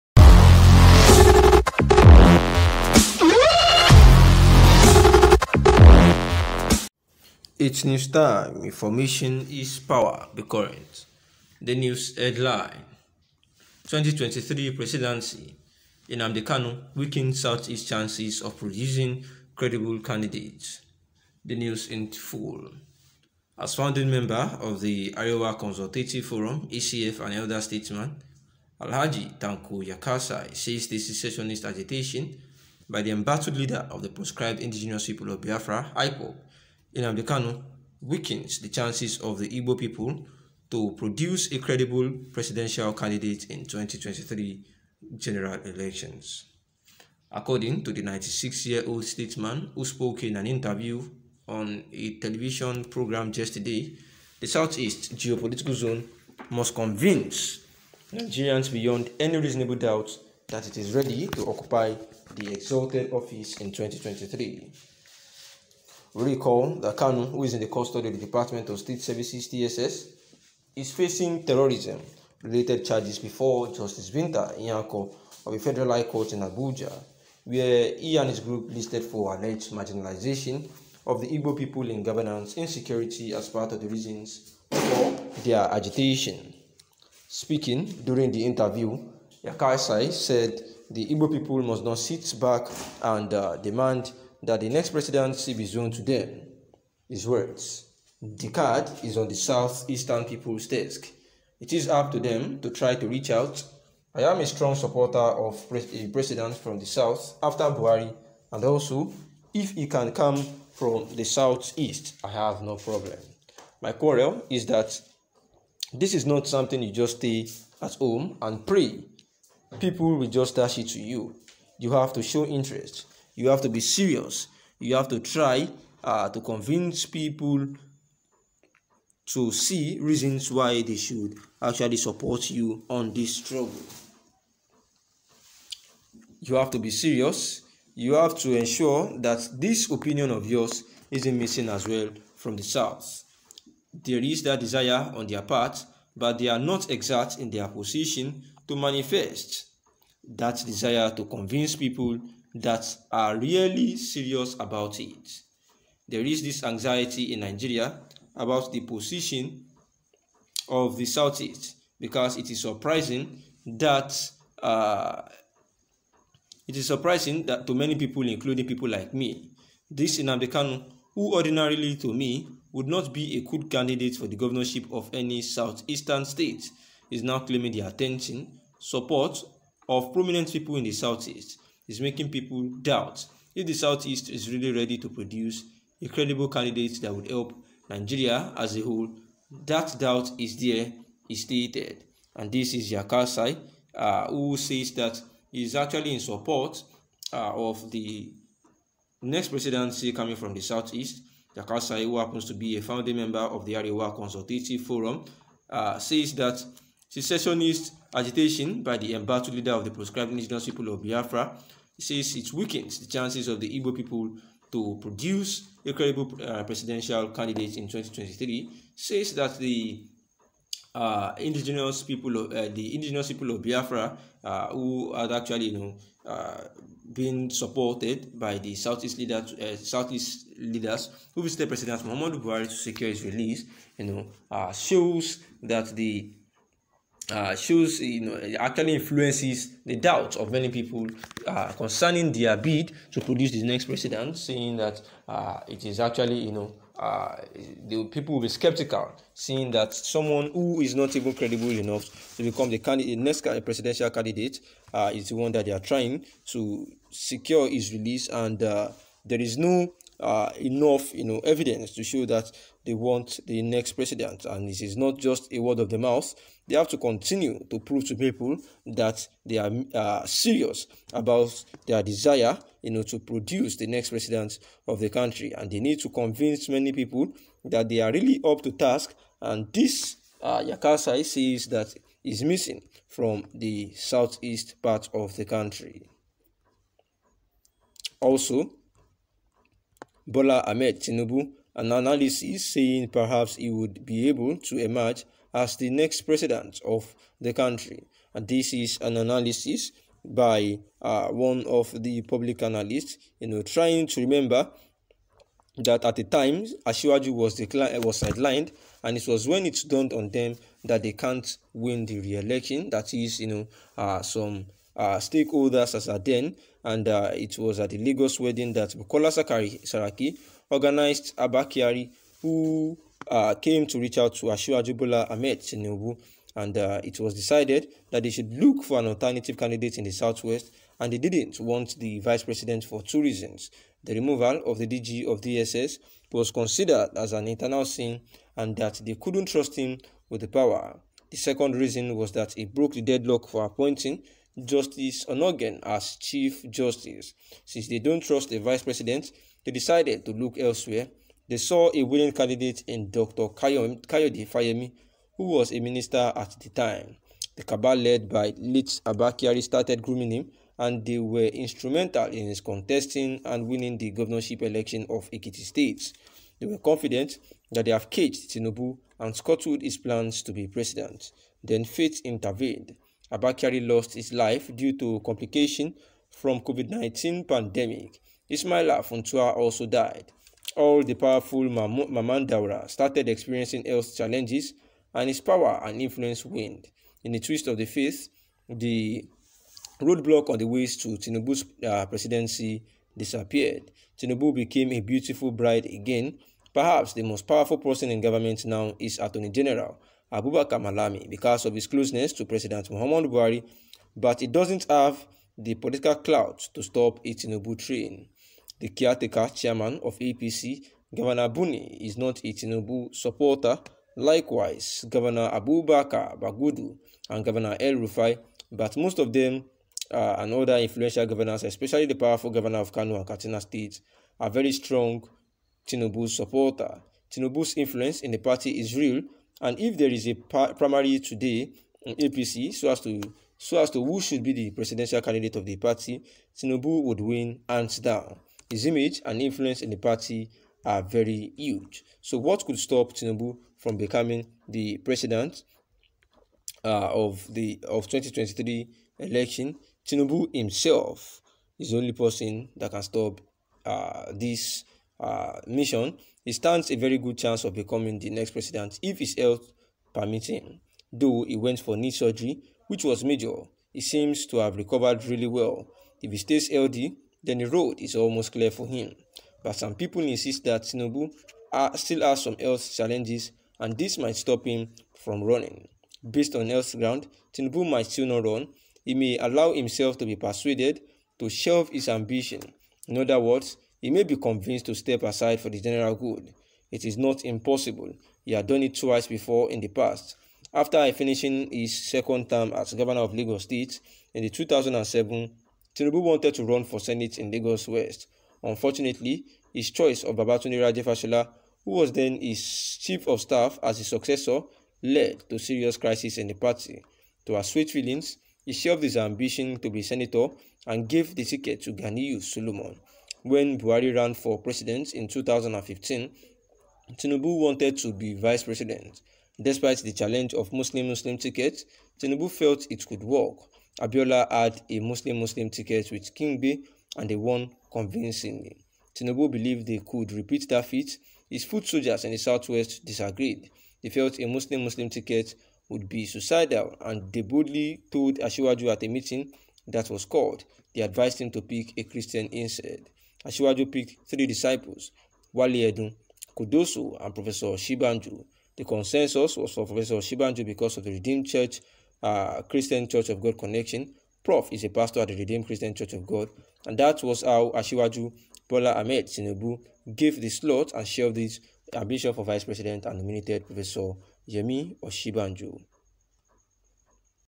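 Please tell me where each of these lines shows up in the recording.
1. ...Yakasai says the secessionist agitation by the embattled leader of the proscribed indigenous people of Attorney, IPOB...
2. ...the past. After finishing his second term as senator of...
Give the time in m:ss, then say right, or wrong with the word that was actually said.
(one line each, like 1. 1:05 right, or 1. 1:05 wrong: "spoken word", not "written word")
1. 0:29 wrong: "Biafra", not "Attorney"
2. 8:09 wrong: "governor", not "senator".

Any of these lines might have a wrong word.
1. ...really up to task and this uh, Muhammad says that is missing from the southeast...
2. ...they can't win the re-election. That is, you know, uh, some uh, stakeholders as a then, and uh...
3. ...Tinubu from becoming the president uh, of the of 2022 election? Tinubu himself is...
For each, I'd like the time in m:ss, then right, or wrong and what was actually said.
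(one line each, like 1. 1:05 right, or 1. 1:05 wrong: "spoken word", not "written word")
1. 4:38 wrong: "Yakasai", not "Muhammad"
2. 5:11 right
3. 7:23 wrong: "2023", not "2022".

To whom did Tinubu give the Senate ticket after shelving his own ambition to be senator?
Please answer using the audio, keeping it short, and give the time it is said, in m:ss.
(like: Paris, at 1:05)
Ganiyu Solomon, at 8:31.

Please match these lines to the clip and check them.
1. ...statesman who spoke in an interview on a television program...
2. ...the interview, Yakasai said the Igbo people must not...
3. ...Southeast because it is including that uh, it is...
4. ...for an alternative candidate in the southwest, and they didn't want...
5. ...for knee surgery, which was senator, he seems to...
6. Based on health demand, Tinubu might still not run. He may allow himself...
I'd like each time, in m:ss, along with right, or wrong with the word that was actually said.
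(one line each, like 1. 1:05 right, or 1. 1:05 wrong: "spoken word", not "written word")
1. 0:49 right
2. 1:28 right
3. 2:41 wrong: "surprising", not "including"
4. 5:28 right
5. 7:41 wrong: "major", not "senator"
6. 7:56 wrong: "ground", not "demand".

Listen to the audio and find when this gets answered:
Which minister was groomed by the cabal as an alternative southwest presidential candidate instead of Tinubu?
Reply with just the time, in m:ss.
5:53.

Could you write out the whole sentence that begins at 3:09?
That doubt is there, is stated.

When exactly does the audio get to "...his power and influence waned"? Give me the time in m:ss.
6:25.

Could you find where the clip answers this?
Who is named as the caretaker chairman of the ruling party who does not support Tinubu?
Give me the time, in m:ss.
6:51.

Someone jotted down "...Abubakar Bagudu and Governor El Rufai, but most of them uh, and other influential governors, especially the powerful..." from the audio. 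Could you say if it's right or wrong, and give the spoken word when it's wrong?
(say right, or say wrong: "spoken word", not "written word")
right.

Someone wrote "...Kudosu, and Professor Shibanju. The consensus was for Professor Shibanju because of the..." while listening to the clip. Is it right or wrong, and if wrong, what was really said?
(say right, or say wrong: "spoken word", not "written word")
right.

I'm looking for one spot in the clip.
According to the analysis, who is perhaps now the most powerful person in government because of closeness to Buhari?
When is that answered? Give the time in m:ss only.
6:40.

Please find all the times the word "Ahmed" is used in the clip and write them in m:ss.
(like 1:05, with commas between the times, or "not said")
4:50, 5:25, 9:18.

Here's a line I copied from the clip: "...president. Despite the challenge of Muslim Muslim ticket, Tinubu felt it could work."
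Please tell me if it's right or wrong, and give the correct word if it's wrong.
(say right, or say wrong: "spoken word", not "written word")
right.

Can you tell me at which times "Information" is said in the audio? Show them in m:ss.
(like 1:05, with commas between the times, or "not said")
0:08.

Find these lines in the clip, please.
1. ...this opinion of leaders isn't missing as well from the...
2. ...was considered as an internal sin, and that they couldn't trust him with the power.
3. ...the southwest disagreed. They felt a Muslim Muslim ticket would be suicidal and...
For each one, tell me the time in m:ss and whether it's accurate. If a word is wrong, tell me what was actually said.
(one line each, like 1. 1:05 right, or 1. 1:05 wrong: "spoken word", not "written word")
1. 2:19 wrong: "yours", not "leaders"
2. 5:36 right
3. 8:52 right.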